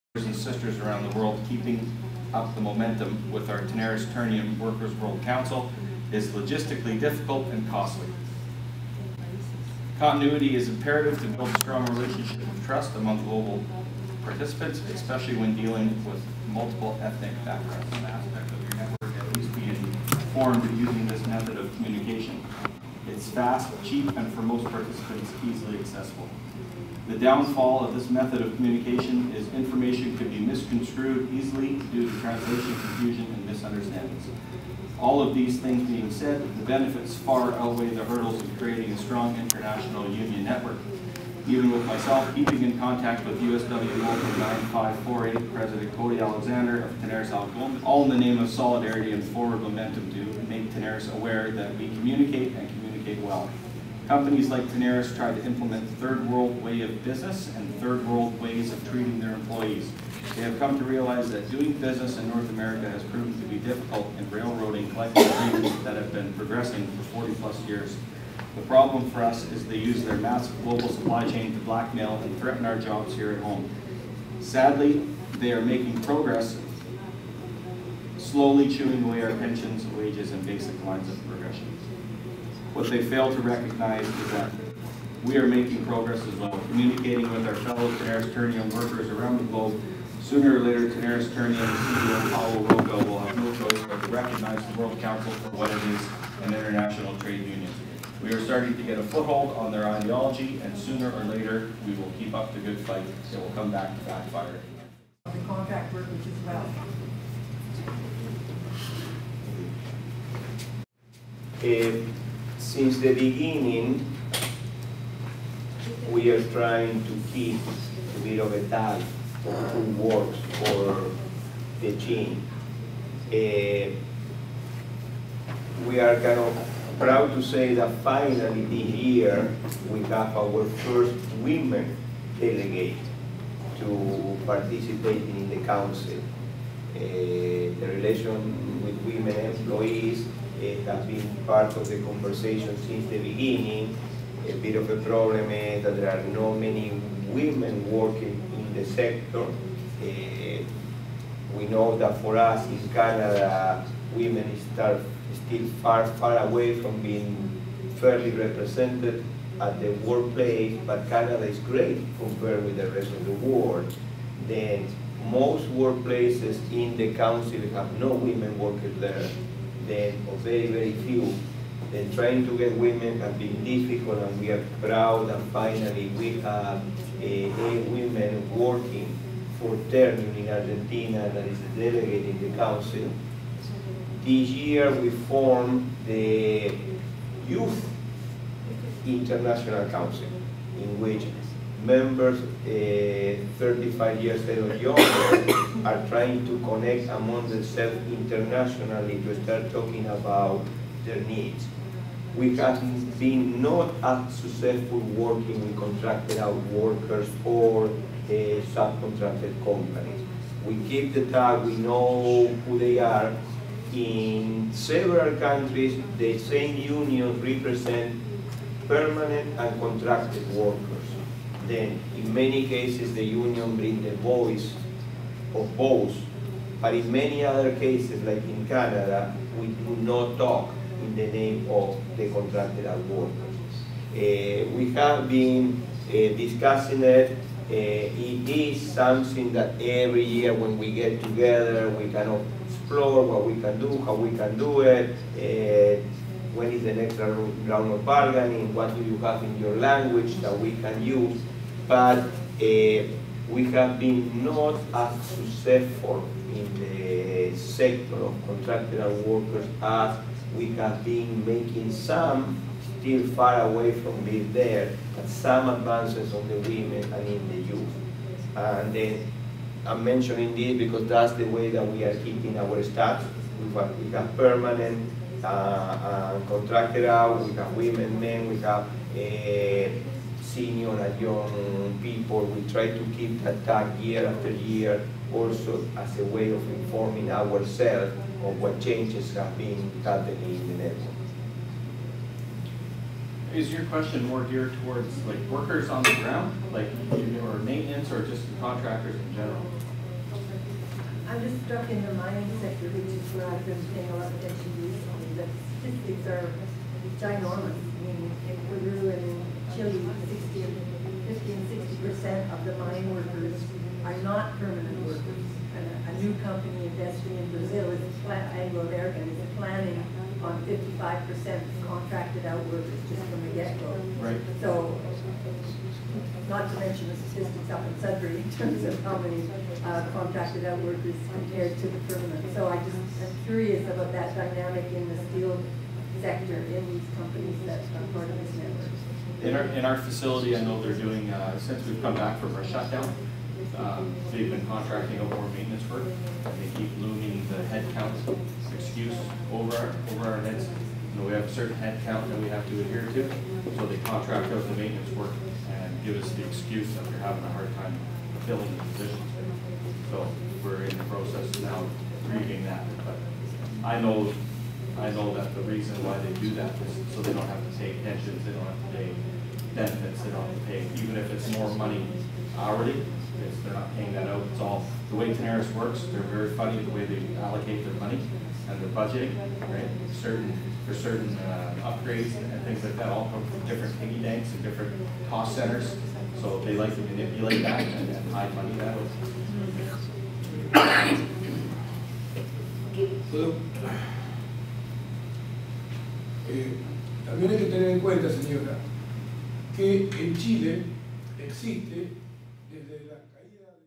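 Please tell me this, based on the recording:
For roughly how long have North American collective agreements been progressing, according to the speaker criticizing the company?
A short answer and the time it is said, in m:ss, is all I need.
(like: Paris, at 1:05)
40 plus years, at 1:07.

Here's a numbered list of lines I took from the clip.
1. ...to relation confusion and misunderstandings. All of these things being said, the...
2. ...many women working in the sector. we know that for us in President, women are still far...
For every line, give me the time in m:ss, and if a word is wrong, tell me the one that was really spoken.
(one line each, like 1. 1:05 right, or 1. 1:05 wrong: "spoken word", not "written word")
1. 0:32 wrong: "translation", not "relation"
2. 2:26 wrong: "Canada", not "President".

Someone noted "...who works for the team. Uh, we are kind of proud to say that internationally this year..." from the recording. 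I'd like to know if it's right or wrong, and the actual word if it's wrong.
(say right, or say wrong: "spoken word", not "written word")
wrong: "finally", not "internationally".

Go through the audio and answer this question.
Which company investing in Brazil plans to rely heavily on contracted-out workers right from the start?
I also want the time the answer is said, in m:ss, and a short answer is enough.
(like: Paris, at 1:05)
Anglo-American, at 5:18.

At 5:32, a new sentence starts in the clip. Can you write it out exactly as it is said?
So I just am curious about that dynamic in the steel sector in these companies that are part of this network.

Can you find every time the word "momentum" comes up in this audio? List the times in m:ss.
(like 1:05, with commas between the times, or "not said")
0:02, 0:49.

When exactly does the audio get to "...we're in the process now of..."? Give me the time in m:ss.
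6:00.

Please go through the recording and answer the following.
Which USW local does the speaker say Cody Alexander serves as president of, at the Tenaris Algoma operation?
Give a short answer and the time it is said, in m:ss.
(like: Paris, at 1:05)
Local 9548, at 0:43.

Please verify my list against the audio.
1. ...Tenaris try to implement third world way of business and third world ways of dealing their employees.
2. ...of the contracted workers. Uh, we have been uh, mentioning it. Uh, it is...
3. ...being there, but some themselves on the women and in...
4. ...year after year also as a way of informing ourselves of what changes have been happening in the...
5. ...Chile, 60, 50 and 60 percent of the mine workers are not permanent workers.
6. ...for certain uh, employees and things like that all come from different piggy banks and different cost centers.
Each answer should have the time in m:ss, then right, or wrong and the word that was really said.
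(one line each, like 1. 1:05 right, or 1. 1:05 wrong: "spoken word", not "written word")
1. 0:54 wrong: "treating", not "dealing"
2. 3:51 wrong: "discussing", not "mentioning"
3. 4:24 wrong: "advances", not "themselves"
4. 4:43 right
5. 5:09 right
6. 6:20 wrong: "upgrades", not "employees".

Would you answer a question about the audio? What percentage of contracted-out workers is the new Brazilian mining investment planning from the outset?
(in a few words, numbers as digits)
55%.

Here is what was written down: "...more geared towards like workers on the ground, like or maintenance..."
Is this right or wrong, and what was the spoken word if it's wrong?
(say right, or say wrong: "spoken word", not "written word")
right.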